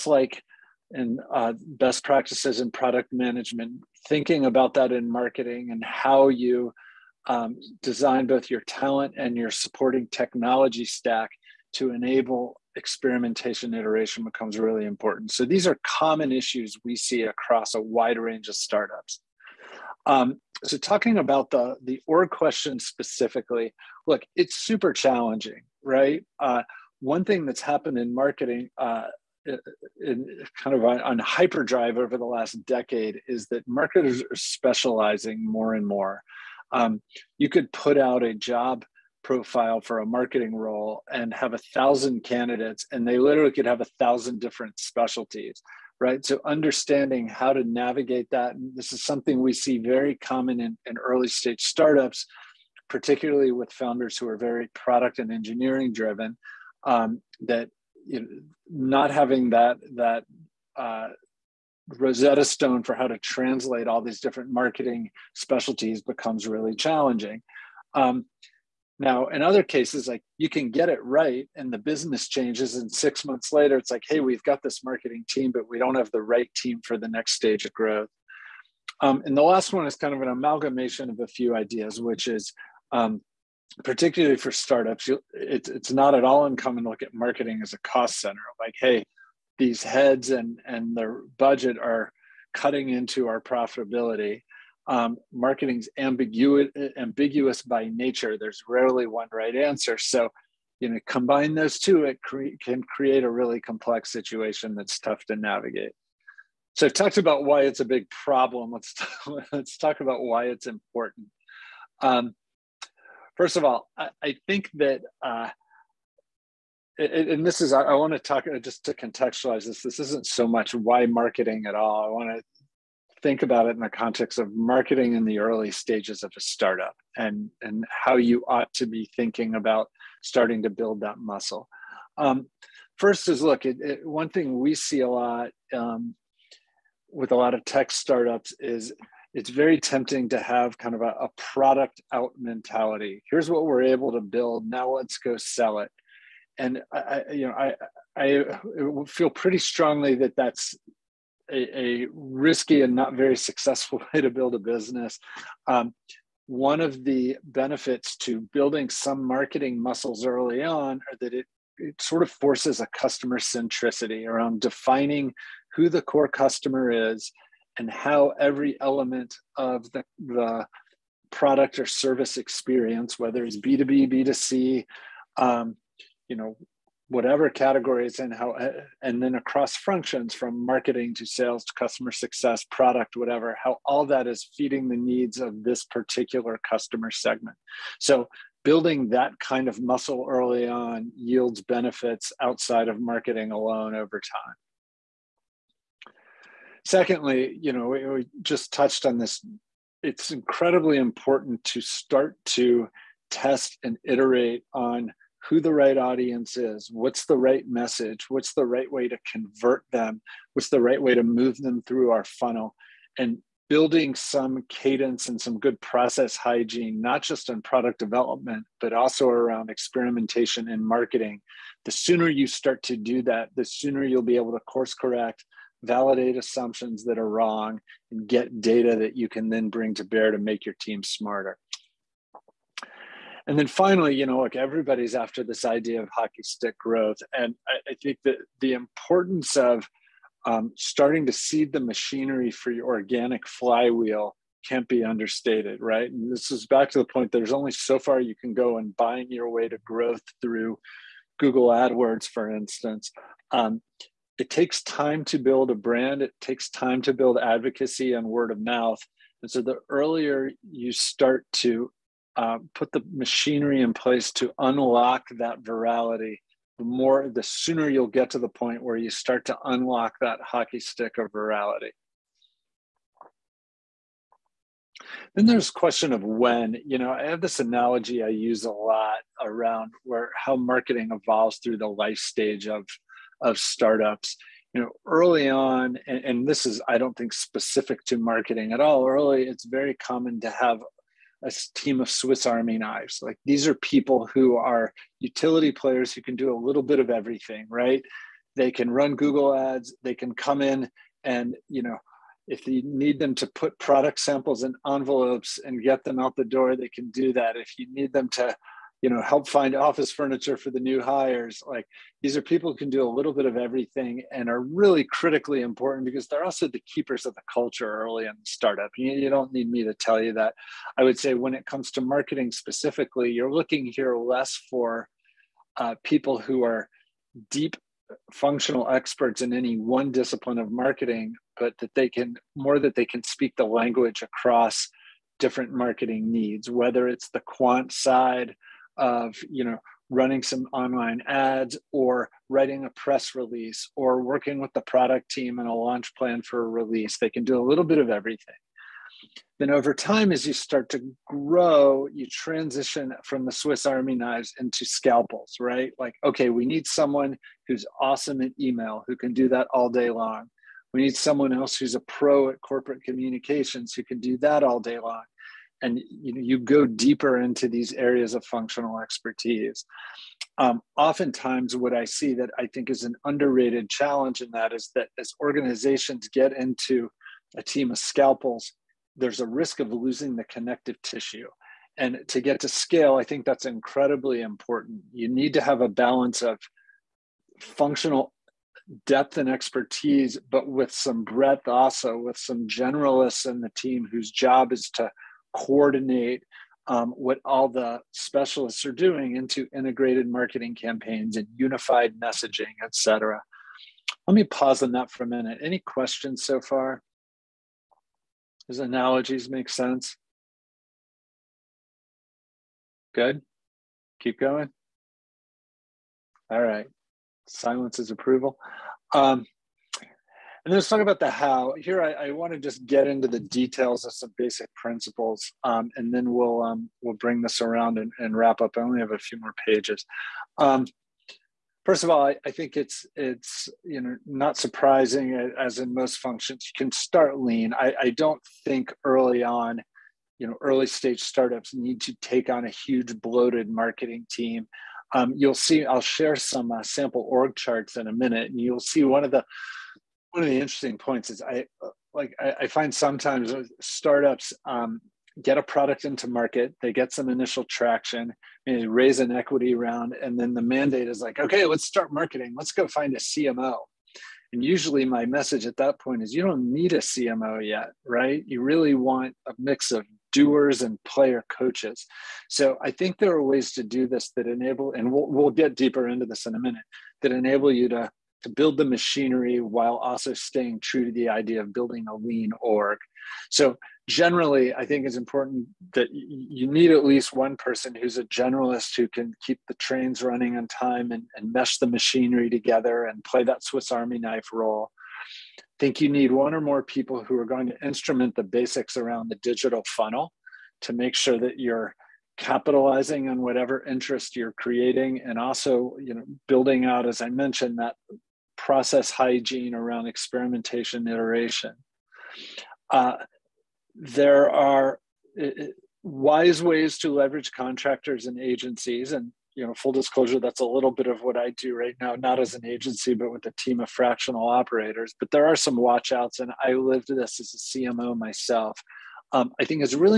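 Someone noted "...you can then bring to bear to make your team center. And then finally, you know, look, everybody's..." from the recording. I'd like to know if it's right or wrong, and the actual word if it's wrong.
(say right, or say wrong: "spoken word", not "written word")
wrong: "smarter", not "center".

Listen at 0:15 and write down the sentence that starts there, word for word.
So these are common issues we see across a wide range of startups.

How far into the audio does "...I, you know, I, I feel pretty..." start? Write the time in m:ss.
2:26.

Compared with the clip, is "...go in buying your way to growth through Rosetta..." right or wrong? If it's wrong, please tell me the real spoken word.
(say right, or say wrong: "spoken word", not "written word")
wrong: "Google", not "Rosetta".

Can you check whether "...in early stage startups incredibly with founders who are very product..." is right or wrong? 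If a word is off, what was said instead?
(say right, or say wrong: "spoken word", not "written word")
wrong: "particularly", not "incredibly".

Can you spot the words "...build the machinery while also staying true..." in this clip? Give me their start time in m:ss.
7:58.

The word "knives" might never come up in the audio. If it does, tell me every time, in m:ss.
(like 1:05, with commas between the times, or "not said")
4:52, 5:54.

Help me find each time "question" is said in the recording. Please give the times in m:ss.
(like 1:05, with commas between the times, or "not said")
0:22, 4:35, 6:45.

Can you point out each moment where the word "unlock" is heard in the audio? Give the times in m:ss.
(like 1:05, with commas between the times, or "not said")
4:24, 4:29.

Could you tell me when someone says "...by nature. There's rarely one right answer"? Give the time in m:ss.
1:37.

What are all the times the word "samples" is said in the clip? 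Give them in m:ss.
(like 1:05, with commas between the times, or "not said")
5:04, 7:26.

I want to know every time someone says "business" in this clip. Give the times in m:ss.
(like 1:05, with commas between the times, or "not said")
1:11, 2:34.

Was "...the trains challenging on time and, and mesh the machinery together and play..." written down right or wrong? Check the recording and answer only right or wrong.
wrong.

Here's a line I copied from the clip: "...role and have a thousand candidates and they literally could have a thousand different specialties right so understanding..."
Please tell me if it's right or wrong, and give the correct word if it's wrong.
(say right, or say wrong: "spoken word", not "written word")
right.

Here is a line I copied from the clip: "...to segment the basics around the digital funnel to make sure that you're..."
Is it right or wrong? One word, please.
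wrong.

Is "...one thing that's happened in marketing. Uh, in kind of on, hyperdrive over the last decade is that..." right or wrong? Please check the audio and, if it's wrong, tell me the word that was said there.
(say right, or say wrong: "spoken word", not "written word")
right.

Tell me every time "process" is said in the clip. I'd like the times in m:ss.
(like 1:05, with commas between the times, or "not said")
3:35, 8:28.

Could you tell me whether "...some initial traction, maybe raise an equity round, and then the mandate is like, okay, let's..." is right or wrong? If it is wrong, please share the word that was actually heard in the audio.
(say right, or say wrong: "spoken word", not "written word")
right.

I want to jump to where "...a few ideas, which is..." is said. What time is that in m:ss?
1:21.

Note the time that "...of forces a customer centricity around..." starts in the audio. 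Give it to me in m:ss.
2:42.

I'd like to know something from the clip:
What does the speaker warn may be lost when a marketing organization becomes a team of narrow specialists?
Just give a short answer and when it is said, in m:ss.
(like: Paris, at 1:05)
connective tissue, at 6:20.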